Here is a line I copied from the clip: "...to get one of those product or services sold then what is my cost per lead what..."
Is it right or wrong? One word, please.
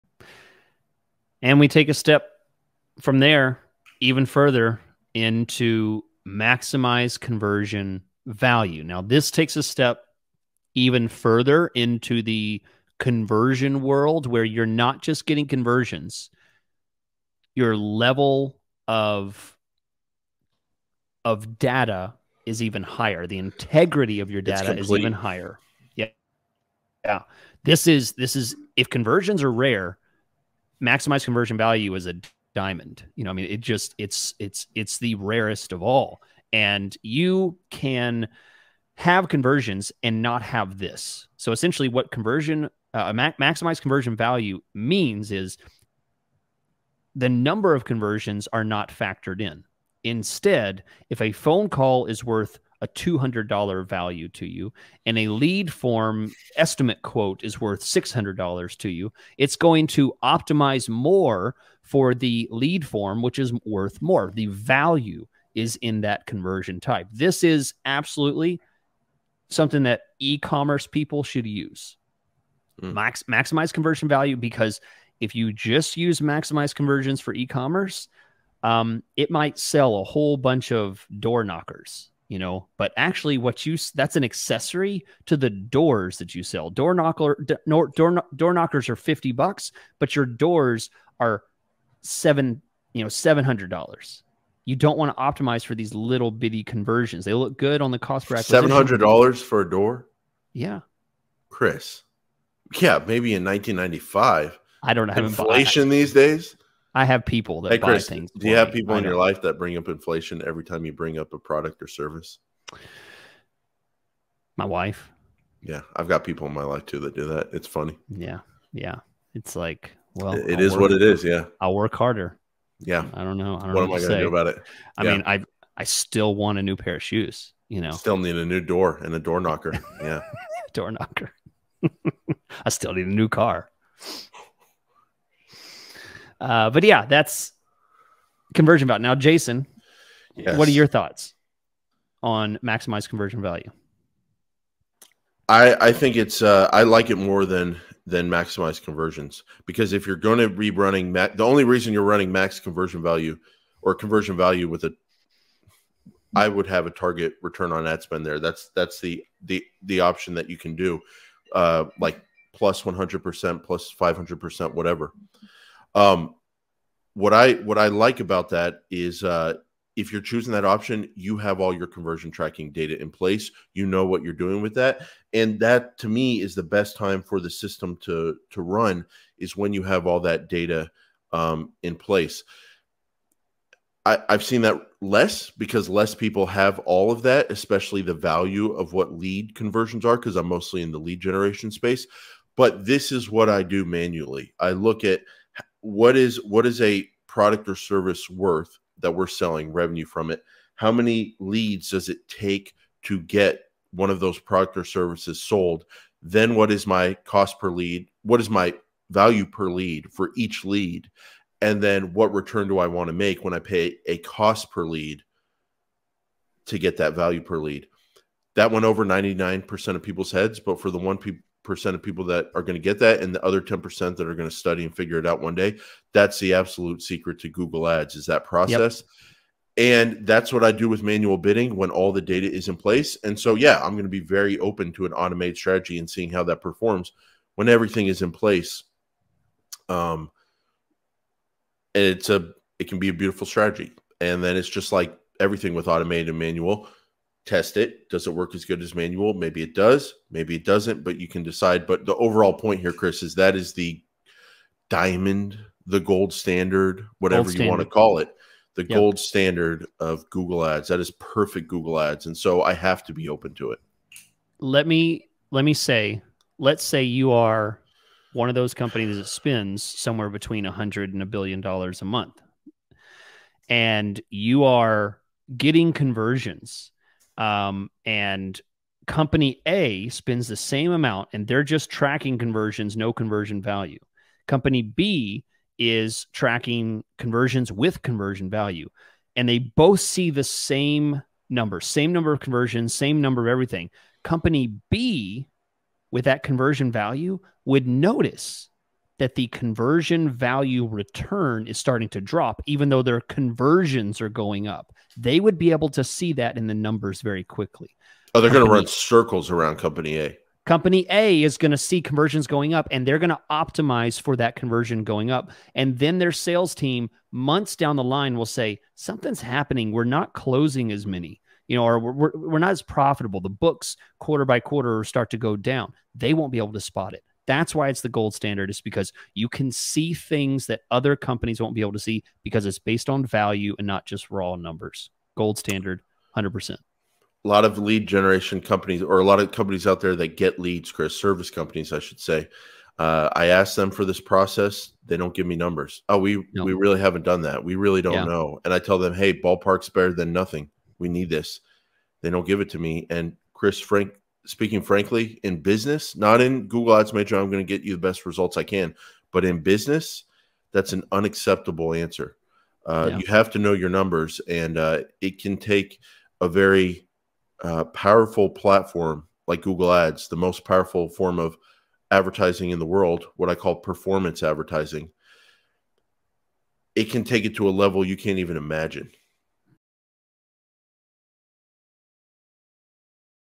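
right.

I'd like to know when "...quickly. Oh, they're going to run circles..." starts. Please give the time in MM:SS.
05:07.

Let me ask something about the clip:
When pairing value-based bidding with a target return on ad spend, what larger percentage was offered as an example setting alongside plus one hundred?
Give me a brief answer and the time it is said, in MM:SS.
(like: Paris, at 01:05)
plus 500%, at 02:43.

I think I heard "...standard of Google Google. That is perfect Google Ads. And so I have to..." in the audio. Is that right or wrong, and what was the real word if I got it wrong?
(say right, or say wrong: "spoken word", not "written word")
wrong: "Ads", not "Google".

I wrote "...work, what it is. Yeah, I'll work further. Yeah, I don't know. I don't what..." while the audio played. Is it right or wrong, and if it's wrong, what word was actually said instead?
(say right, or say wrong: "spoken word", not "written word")
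wrong: "harder", not "further".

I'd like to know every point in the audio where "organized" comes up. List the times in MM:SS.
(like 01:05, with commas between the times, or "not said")
not said.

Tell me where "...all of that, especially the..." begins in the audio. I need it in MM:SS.
03:06.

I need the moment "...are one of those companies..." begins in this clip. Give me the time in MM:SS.
04:27.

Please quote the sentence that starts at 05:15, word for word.
And then their sales team, months down the line, will say, Something's happening.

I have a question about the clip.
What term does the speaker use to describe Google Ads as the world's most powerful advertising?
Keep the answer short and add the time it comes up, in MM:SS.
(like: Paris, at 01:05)
performance advertising, at 06:13.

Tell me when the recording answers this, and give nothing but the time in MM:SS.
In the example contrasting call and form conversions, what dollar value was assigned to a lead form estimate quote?
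00:57.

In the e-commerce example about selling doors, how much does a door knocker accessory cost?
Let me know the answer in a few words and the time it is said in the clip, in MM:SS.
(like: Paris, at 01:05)
50 bucks, at 01:28.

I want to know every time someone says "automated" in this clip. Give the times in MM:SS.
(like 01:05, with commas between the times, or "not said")
03:55, 04:05.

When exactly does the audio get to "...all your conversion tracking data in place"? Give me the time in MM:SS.
02:51.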